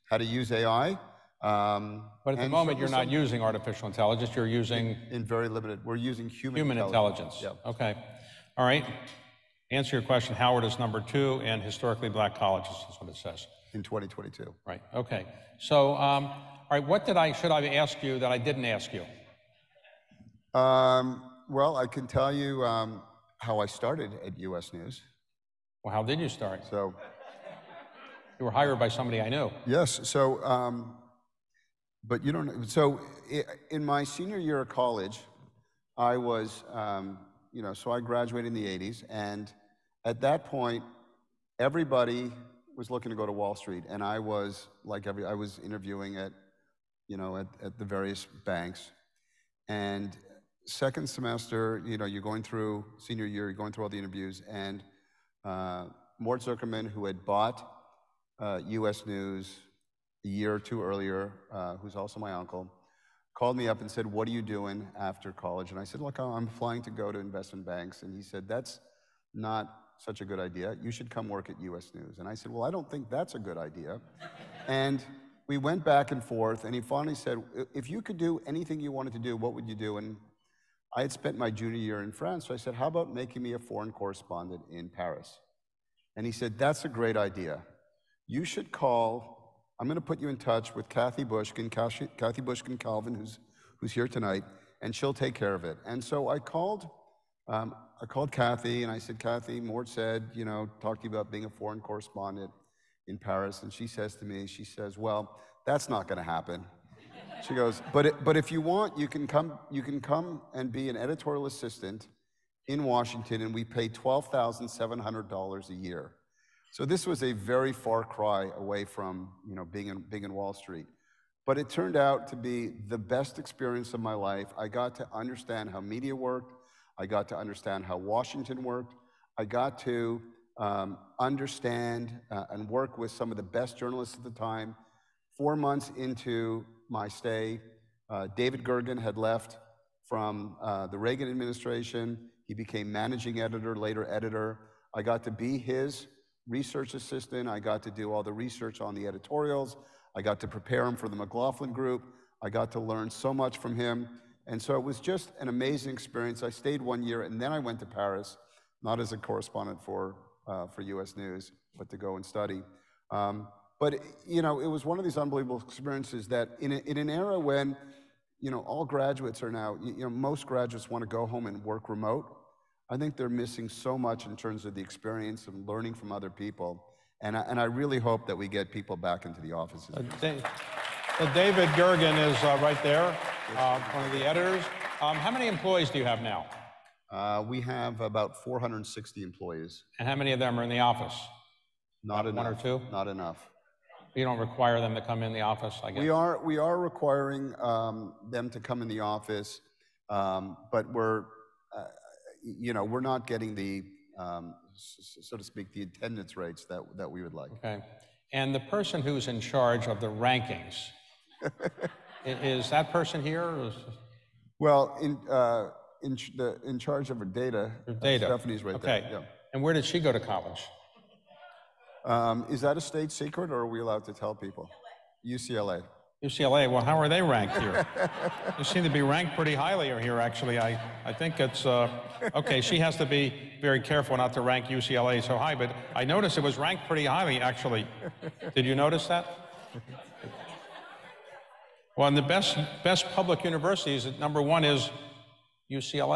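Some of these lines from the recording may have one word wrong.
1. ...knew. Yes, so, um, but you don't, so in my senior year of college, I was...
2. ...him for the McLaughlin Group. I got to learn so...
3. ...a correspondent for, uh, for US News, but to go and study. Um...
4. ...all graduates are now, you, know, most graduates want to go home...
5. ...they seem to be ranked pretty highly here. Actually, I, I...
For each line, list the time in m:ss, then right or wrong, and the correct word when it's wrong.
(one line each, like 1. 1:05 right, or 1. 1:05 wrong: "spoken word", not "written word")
1. 0:29 right
2. 2:30 right
3. 2:39 right
4. 2:48 right
5. 3:48 right.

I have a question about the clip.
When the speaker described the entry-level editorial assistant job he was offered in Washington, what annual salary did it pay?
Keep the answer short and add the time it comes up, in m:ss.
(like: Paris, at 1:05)
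$12,700, at 1:53.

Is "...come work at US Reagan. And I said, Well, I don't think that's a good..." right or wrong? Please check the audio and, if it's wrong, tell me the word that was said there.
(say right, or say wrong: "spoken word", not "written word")
wrong: "News", not "Reagan".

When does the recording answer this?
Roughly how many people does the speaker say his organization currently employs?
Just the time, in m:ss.
3:08.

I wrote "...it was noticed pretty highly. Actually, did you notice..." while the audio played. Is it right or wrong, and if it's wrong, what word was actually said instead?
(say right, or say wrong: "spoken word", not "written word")
wrong: "ranked", not "noticed".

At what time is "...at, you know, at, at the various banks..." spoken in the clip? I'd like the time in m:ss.
0:46.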